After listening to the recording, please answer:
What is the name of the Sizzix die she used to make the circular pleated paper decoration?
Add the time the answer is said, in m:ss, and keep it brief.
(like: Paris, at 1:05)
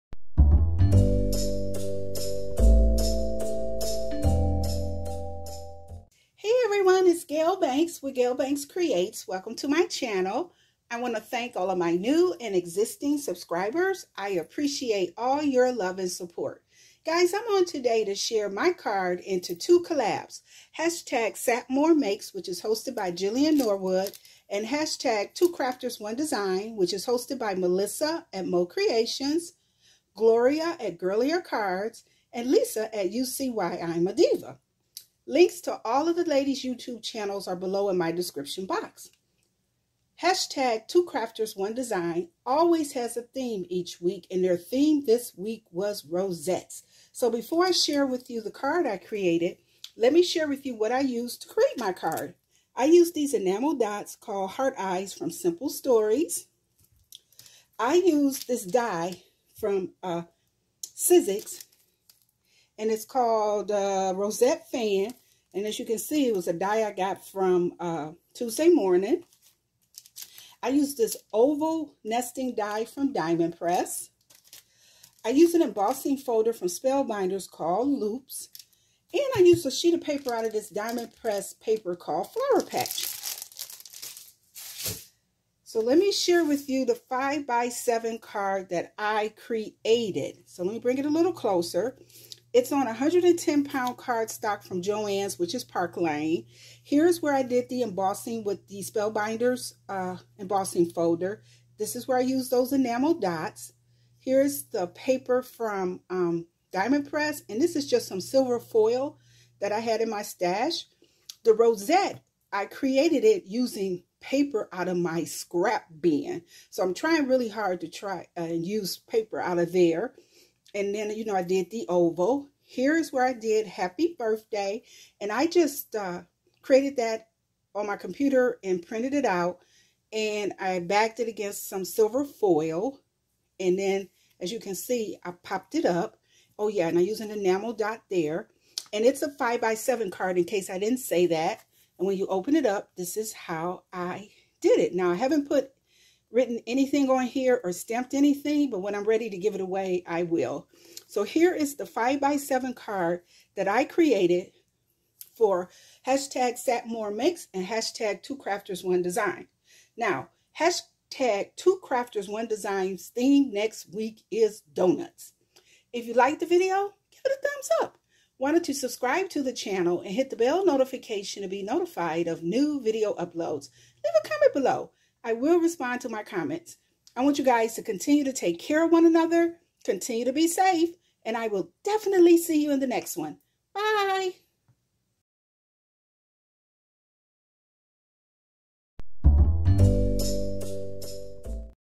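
Rosette Fan, at 1:04.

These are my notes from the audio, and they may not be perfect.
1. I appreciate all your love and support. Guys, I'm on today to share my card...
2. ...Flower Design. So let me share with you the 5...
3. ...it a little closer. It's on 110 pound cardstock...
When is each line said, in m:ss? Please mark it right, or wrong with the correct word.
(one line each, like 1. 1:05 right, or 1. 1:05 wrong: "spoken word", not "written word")
1. 0:14 right
2. 1:22 wrong: "Patch", not "Design"
3. 1:30 right.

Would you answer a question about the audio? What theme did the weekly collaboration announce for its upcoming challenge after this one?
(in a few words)
donuts.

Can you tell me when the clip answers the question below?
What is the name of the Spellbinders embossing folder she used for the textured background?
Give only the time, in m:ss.
1:17.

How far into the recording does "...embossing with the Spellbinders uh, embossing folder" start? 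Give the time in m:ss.
1:37.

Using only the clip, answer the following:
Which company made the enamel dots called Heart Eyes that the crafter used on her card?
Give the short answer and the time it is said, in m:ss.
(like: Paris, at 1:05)
Simple Stories, at 0:55.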